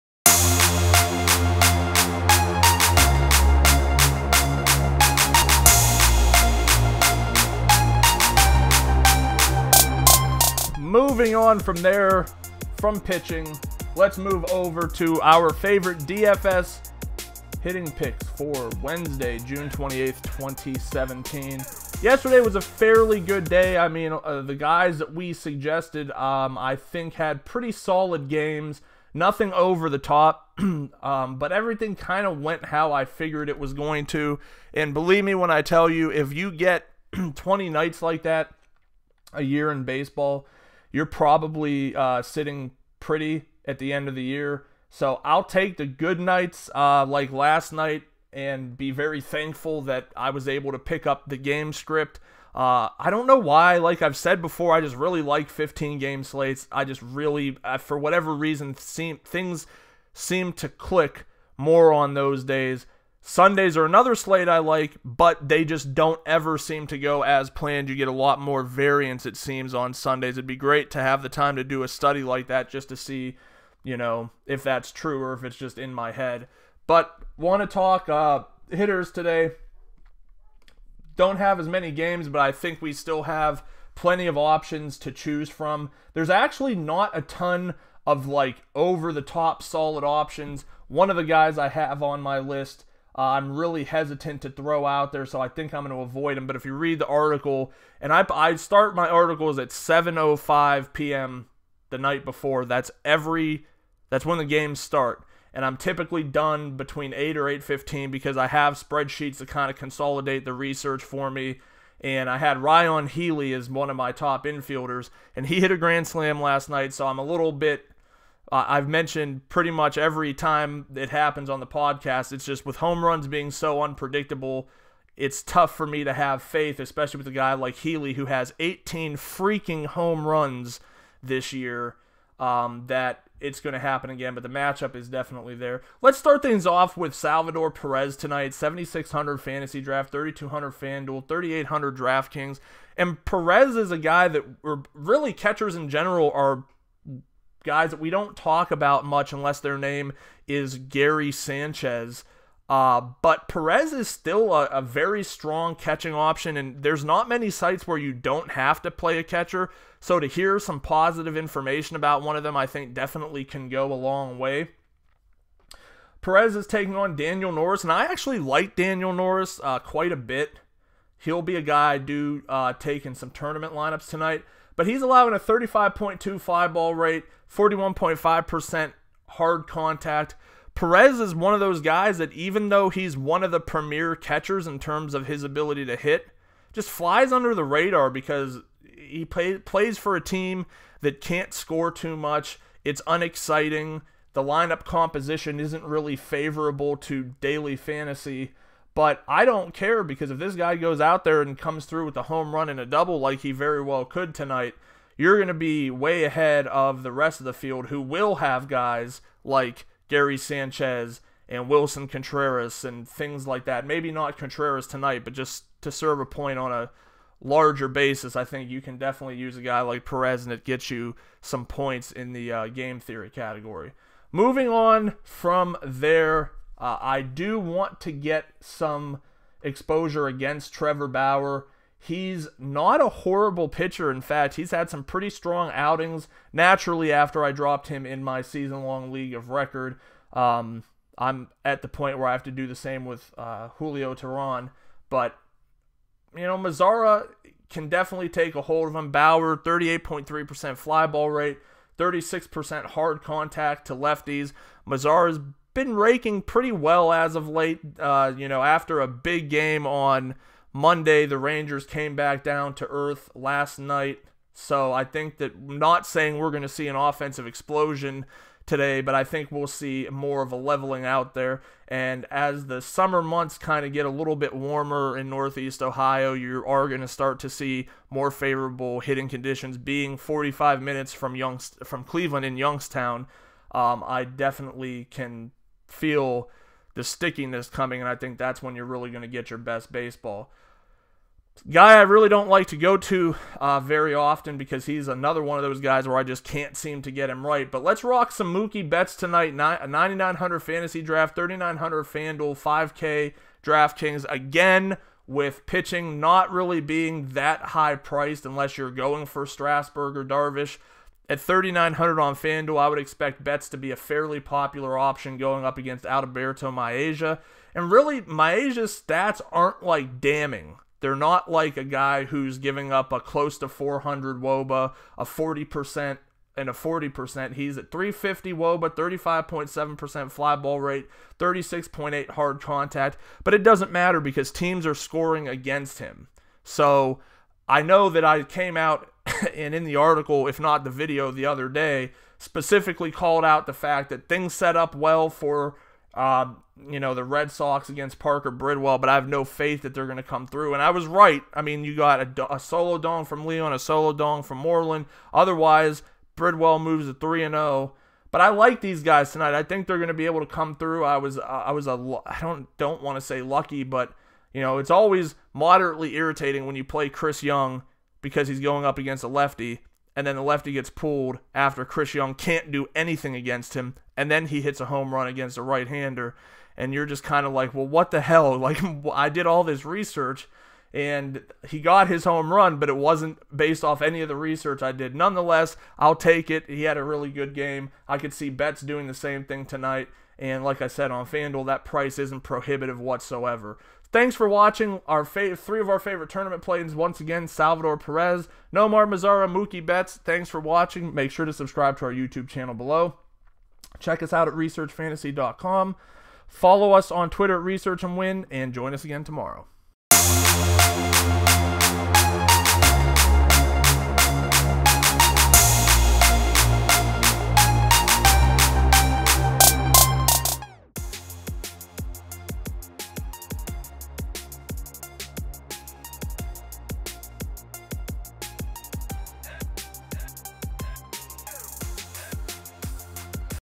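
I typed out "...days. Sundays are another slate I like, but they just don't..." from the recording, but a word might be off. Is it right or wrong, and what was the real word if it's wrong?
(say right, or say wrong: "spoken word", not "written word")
right.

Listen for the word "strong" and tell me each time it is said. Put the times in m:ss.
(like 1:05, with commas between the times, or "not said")
2:35, 3:55.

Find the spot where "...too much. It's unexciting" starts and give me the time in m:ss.
3:11.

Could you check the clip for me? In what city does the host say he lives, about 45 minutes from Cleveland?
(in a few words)
Youngstown.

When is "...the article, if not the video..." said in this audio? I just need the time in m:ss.
5:39.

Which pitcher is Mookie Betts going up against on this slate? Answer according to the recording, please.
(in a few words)
Alberto Mejia.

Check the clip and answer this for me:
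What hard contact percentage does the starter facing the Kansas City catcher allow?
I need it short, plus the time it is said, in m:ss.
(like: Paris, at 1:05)
41.5%, at 2:57.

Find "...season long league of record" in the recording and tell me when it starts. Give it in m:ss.
3:58.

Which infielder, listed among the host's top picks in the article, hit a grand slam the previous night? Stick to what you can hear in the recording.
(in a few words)
Ryan Healy.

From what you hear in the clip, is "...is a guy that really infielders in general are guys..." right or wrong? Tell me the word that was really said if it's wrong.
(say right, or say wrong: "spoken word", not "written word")
wrong: "catchers", not "infielders".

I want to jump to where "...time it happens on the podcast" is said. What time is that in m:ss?
2:00.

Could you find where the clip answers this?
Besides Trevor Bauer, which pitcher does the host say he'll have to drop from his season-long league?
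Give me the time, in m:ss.
4:03.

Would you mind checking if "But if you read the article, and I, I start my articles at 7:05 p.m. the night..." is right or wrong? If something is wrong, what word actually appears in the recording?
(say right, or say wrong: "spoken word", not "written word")
right.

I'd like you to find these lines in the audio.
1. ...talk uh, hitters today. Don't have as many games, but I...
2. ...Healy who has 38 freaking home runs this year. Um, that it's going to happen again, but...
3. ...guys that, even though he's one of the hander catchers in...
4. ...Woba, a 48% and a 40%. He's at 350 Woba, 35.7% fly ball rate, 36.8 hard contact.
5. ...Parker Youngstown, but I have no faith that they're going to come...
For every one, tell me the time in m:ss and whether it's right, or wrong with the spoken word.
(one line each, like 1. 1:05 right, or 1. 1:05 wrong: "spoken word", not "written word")
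1. 1:17 right
2. 2:07 wrong: "18", not "38"
3. 3:01 wrong: "premier", not "hander"
4. 5:24 wrong: "40", not "48"
5. 5:48 wrong: "Bridwell", not "Youngstown".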